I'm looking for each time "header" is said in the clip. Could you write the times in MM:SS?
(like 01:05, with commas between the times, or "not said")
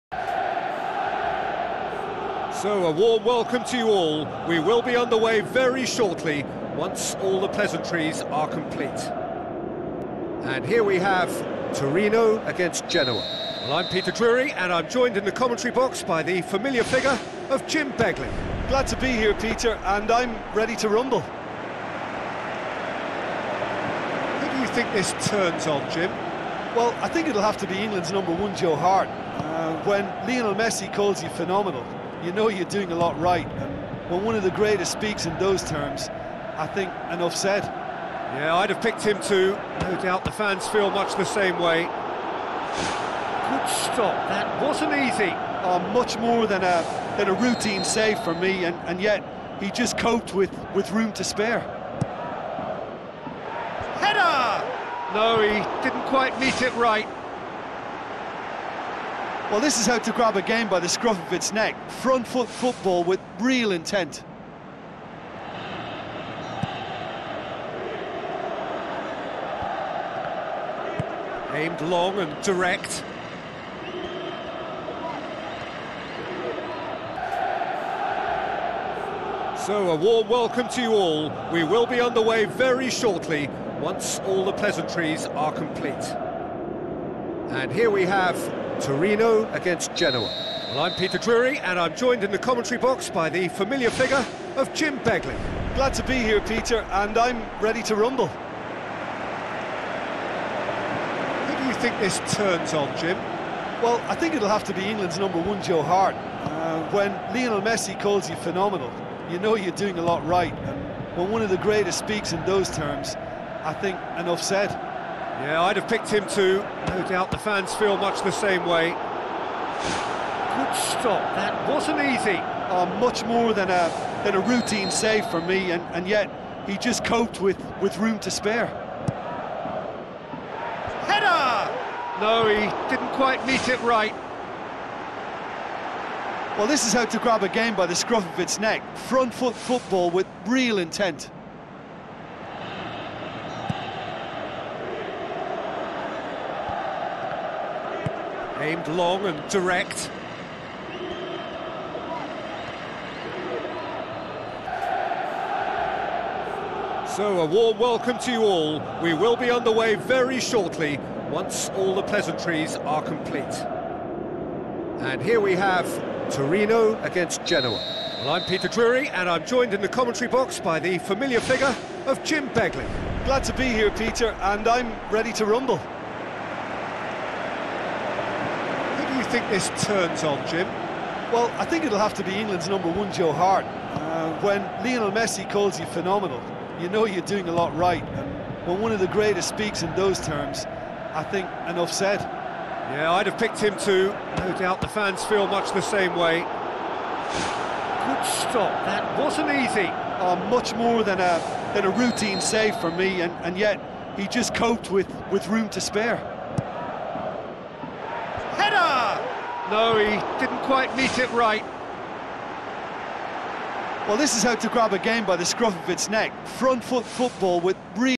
00:53, 02:11, 03:28.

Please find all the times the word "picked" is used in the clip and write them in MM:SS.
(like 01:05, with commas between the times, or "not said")
00:38, 01:55, 03:13.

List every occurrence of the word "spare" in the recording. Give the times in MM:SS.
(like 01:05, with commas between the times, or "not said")
00:51, 02:08, 03:25.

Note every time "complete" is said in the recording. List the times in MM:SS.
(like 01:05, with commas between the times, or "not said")
00:08, 01:25, 02:43.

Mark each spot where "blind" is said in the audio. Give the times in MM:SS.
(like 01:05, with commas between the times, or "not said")
not said.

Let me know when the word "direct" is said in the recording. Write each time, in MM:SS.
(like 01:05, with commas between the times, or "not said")
01:12, 02:29.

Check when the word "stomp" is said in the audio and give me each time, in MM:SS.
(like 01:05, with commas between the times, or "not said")
not said.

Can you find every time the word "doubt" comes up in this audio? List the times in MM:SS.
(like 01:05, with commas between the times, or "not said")
00:40, 01:57, 03:14.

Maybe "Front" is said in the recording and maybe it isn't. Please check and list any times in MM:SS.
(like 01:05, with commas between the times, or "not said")
01:01, 02:18, 03:36.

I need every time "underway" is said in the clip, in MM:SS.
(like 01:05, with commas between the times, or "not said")
00:04, 01:21, 02:39.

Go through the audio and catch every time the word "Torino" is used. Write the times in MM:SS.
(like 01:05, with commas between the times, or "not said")
00:11, 01:28, 02:46.